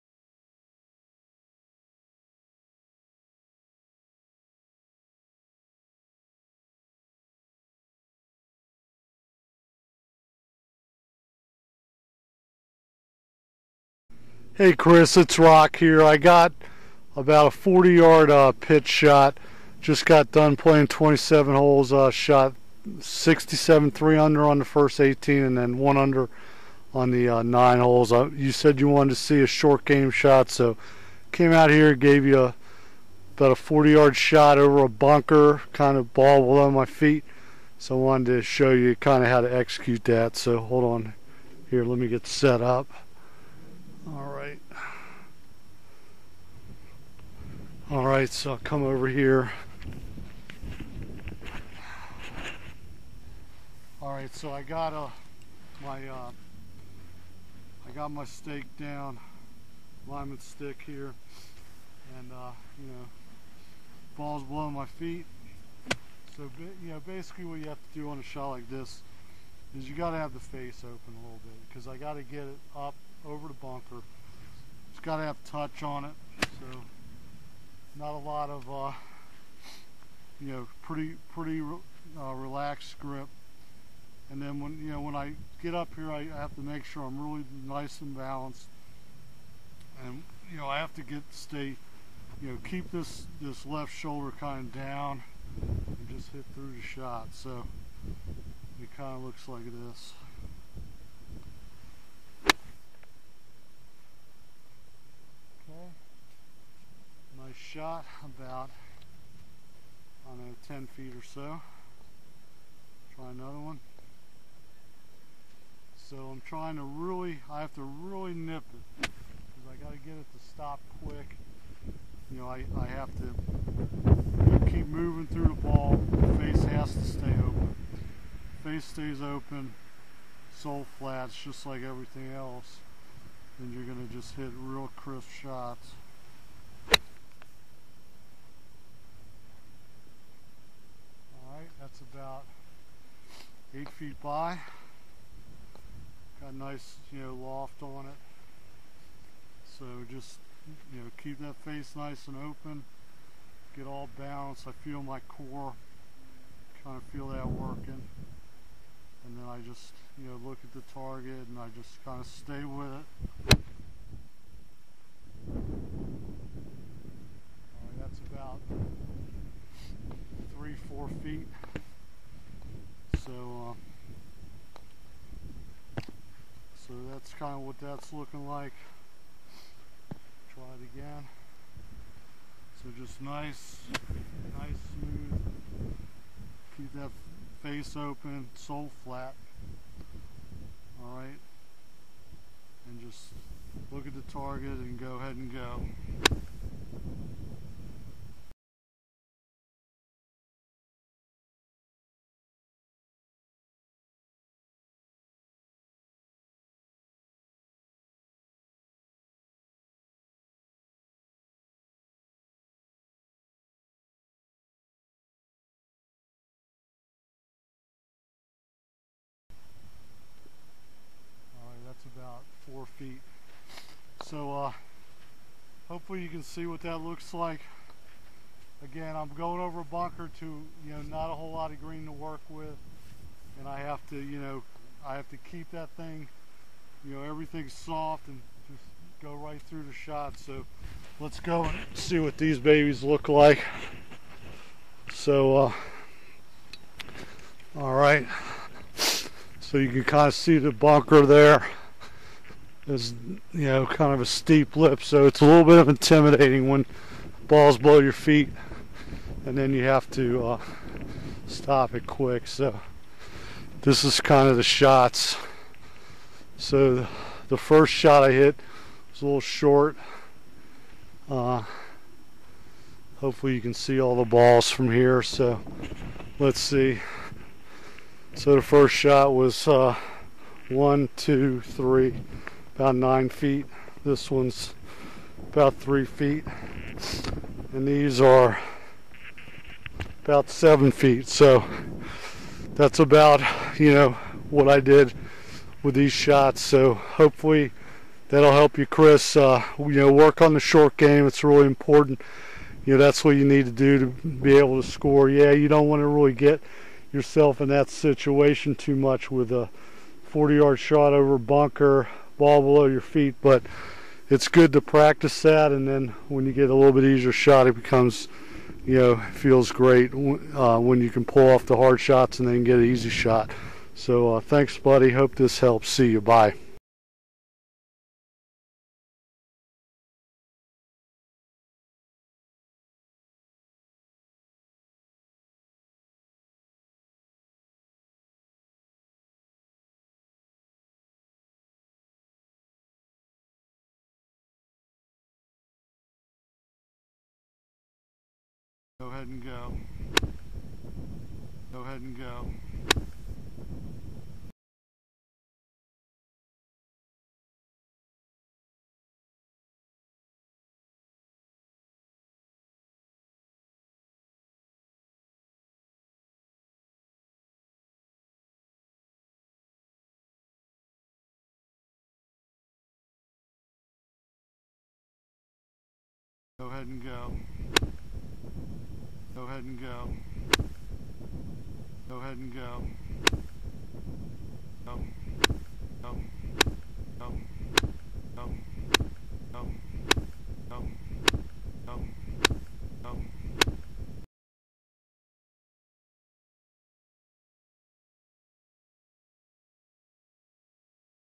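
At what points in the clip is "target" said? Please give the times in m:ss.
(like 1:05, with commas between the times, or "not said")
2:40, 3:14.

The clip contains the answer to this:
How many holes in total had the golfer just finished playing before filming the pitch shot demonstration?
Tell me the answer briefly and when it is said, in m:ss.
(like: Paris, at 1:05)
27, at 0:20.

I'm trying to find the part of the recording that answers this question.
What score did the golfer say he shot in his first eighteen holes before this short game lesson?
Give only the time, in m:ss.
0:22.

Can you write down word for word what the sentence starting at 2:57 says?
that's kind of what that's looking like.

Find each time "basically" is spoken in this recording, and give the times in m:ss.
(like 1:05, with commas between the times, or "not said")
1:07.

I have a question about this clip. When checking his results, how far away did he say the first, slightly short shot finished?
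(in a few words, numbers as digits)
9 feet.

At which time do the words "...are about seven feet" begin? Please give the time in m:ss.
4:48.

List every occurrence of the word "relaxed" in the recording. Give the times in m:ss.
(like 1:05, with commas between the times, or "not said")
1:22.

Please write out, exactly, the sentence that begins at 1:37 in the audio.
So it kind of looks like this.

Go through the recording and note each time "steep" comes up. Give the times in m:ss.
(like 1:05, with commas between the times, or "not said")
4:14.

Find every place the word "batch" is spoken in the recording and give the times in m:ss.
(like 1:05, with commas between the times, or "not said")
not said.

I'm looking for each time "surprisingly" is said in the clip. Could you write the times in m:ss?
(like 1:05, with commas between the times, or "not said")
not said.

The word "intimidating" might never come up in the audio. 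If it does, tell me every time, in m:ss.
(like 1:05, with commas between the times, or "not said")
4:15.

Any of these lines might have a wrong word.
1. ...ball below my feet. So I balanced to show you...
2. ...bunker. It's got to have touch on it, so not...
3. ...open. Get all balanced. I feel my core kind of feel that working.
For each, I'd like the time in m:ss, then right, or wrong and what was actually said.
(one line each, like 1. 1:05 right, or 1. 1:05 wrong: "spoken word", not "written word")
1. 0:36 wrong: "wanted", not "balanced"
2. 1:13 right
3. 2:32 right.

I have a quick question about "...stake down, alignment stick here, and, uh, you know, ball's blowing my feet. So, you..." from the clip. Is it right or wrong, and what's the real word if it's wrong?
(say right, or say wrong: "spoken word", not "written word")
right.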